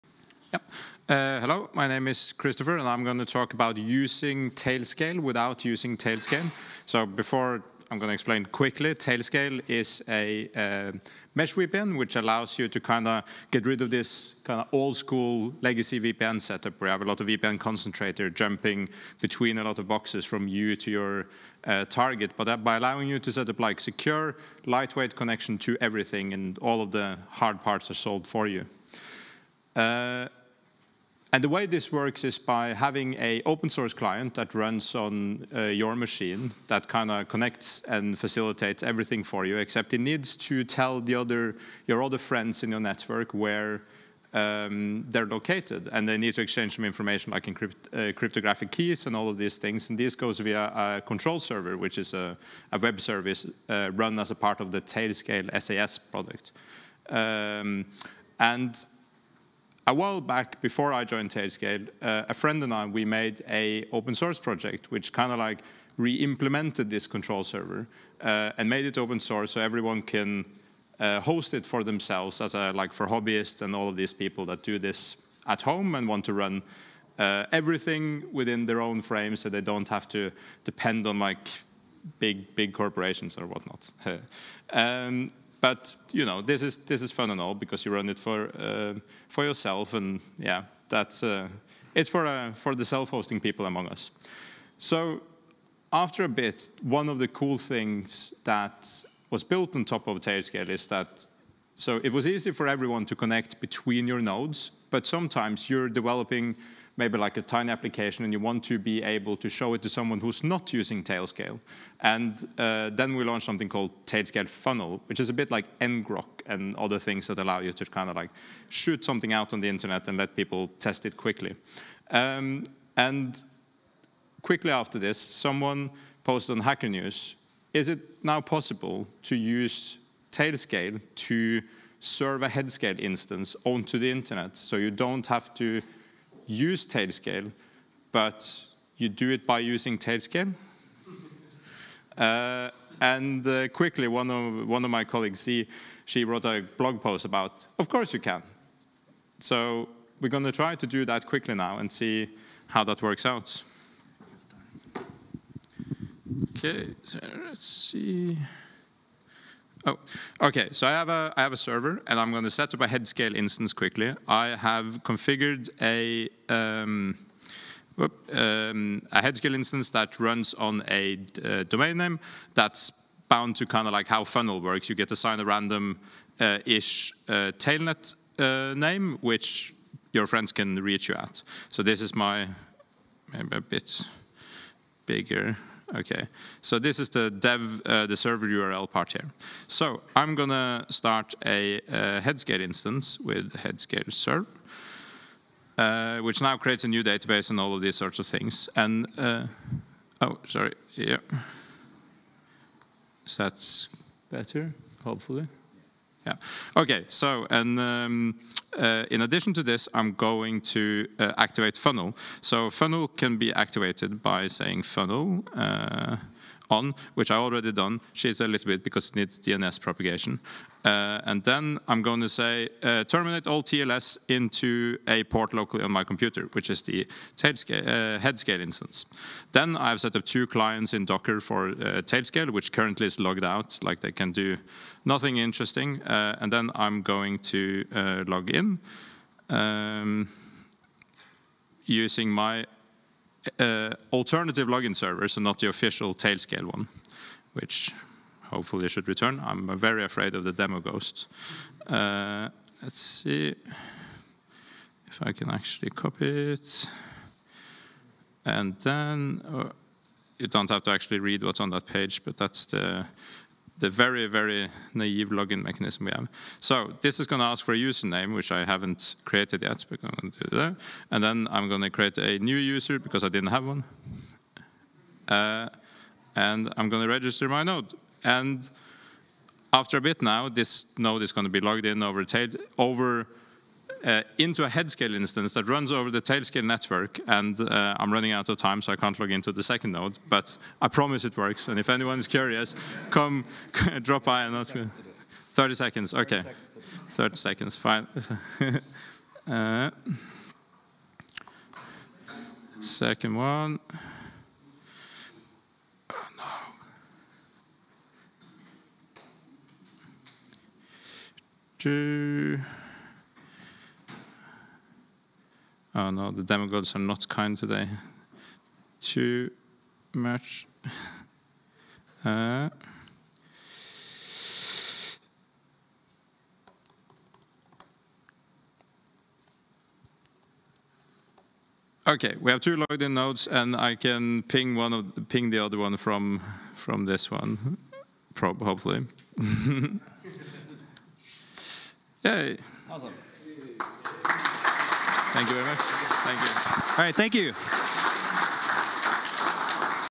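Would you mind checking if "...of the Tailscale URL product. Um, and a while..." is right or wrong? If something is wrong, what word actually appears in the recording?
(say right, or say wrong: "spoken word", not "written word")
wrong: "SaaS", not "URL".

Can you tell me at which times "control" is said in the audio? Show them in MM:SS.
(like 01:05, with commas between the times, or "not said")
00:51, 01:07.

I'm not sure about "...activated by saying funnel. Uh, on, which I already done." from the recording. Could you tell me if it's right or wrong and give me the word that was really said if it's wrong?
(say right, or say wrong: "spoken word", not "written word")
right.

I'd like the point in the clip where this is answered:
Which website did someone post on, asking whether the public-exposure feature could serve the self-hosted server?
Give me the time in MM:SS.
02:06.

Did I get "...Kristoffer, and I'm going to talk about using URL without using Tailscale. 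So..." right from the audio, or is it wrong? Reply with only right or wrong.
wrong.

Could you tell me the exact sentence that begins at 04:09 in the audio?
I'm very afraid of the demo ghost.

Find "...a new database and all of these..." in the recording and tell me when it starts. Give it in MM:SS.
03:16.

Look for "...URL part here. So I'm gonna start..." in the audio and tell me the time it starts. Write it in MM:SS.
03:08.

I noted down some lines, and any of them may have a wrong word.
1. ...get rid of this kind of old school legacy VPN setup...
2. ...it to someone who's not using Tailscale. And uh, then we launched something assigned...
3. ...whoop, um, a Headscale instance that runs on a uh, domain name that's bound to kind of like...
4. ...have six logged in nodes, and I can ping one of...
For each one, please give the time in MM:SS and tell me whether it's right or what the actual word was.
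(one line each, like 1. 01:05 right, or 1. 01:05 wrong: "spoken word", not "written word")
1. 00:13 right
2. 01:49 wrong: "called", not "assigned"
3. 02:47 right
4. 05:32 wrong: "two", not "six".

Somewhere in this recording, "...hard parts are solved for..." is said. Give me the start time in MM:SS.
00:27.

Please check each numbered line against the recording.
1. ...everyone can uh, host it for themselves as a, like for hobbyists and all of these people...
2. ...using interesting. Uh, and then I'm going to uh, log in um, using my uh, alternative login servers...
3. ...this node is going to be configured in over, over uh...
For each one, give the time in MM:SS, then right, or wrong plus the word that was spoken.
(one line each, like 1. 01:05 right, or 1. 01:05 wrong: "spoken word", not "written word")
1. 01:09 right
2. 03:55 wrong: "nothing", not "using"
3. 04:40 wrong: "logged", not "configured".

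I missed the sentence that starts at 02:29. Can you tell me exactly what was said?
So we're going to try to do that quickly now and see how that works out.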